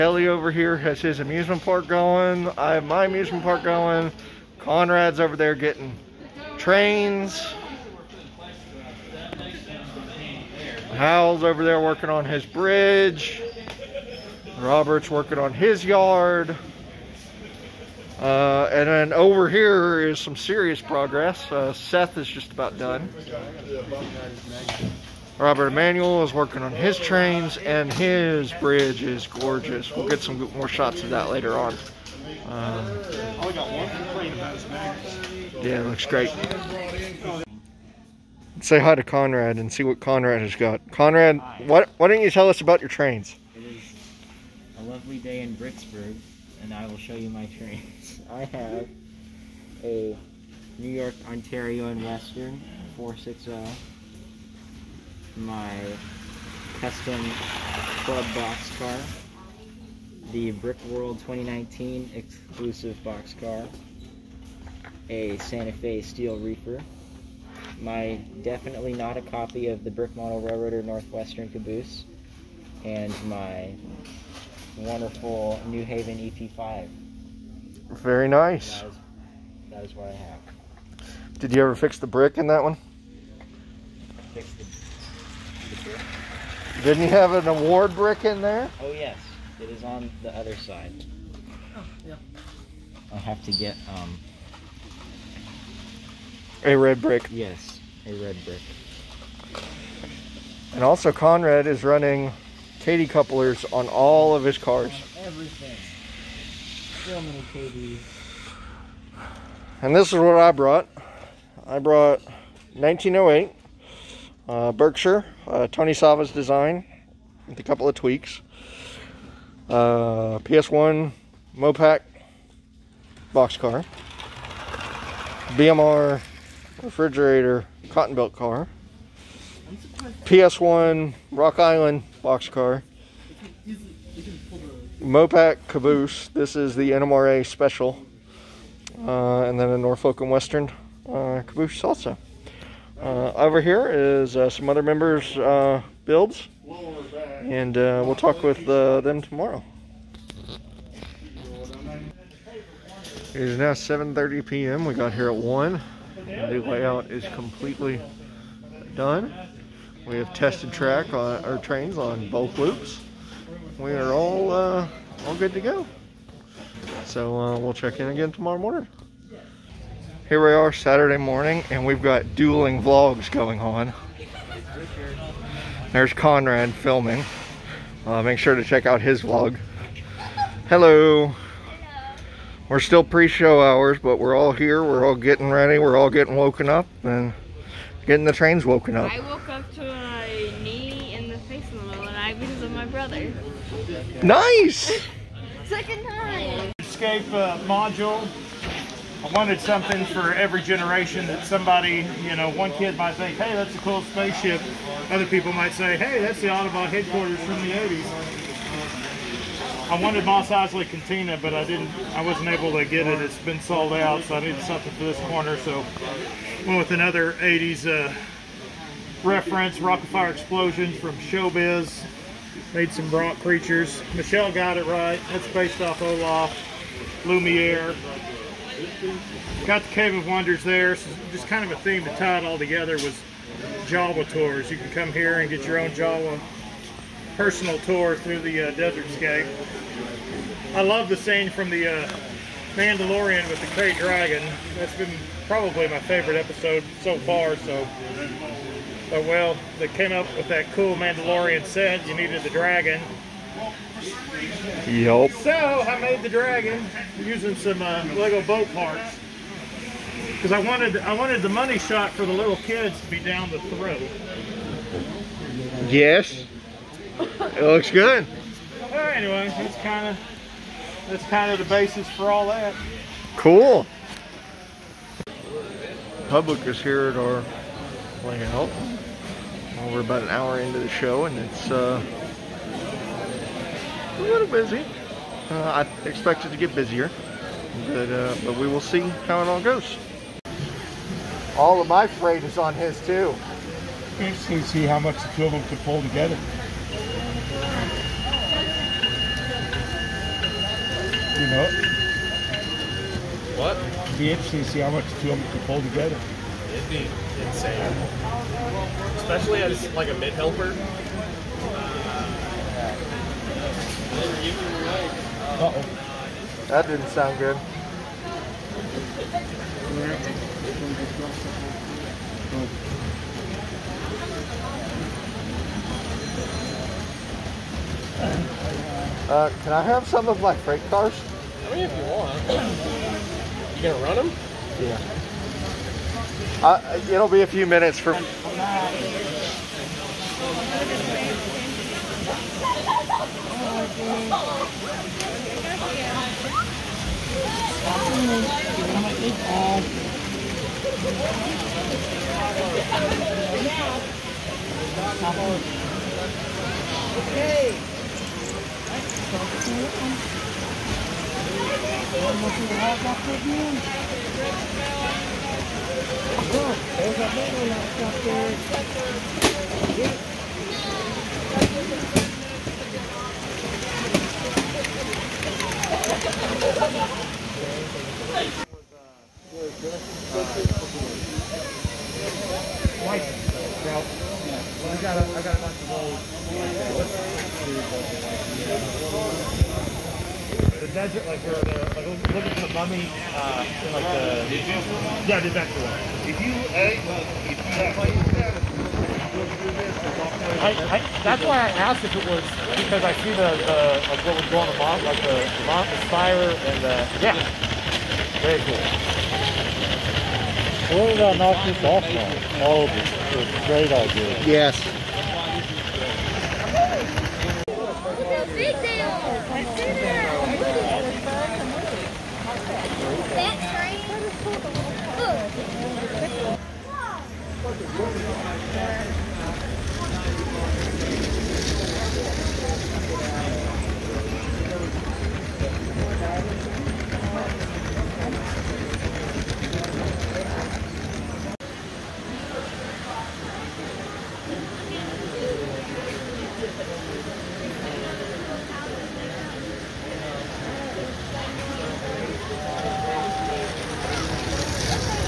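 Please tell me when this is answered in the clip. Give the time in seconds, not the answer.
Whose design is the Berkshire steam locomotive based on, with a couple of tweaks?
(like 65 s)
115 s.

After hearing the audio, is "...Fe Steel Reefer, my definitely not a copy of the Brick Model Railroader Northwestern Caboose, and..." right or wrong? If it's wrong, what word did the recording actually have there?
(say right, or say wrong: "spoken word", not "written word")
right.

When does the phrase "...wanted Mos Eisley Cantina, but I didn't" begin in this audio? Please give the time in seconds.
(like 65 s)
210 s.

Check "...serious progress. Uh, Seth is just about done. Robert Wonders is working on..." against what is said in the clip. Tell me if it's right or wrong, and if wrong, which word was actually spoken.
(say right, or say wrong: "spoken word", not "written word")
wrong: "Emanuel", not "Wonders".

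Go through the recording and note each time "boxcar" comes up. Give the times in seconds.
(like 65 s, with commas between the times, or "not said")
123 s, 132 s.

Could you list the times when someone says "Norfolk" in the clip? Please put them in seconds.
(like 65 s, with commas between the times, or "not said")
139 s.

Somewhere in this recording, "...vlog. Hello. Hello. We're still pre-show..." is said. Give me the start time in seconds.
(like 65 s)
179 s.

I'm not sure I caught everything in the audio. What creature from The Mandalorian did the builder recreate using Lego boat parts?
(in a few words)
Krayt Dragon.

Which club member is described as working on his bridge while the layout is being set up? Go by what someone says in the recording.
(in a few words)
Hal.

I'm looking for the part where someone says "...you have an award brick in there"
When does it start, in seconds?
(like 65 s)
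87 s.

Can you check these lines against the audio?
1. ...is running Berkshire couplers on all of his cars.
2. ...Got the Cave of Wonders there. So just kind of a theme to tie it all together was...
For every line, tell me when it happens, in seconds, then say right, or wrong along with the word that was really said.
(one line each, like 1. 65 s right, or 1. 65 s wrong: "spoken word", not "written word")
1. 101 s wrong: "Kadee", not "Berkshire"
2. 229 s right.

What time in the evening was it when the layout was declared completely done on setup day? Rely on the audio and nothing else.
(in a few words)
7:30 p.m.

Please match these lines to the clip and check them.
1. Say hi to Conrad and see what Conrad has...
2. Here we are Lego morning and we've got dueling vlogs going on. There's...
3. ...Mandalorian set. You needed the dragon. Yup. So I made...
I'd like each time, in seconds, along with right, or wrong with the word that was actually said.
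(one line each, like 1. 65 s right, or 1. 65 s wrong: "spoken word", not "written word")
1. 38 s right
2. 170 s wrong: "Saturday", not "Lego"
3. 250 s right.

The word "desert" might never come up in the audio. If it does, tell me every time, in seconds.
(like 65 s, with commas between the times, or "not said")
238 s, 376 s, 395 s.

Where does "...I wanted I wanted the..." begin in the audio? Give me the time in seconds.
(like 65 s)
260 s.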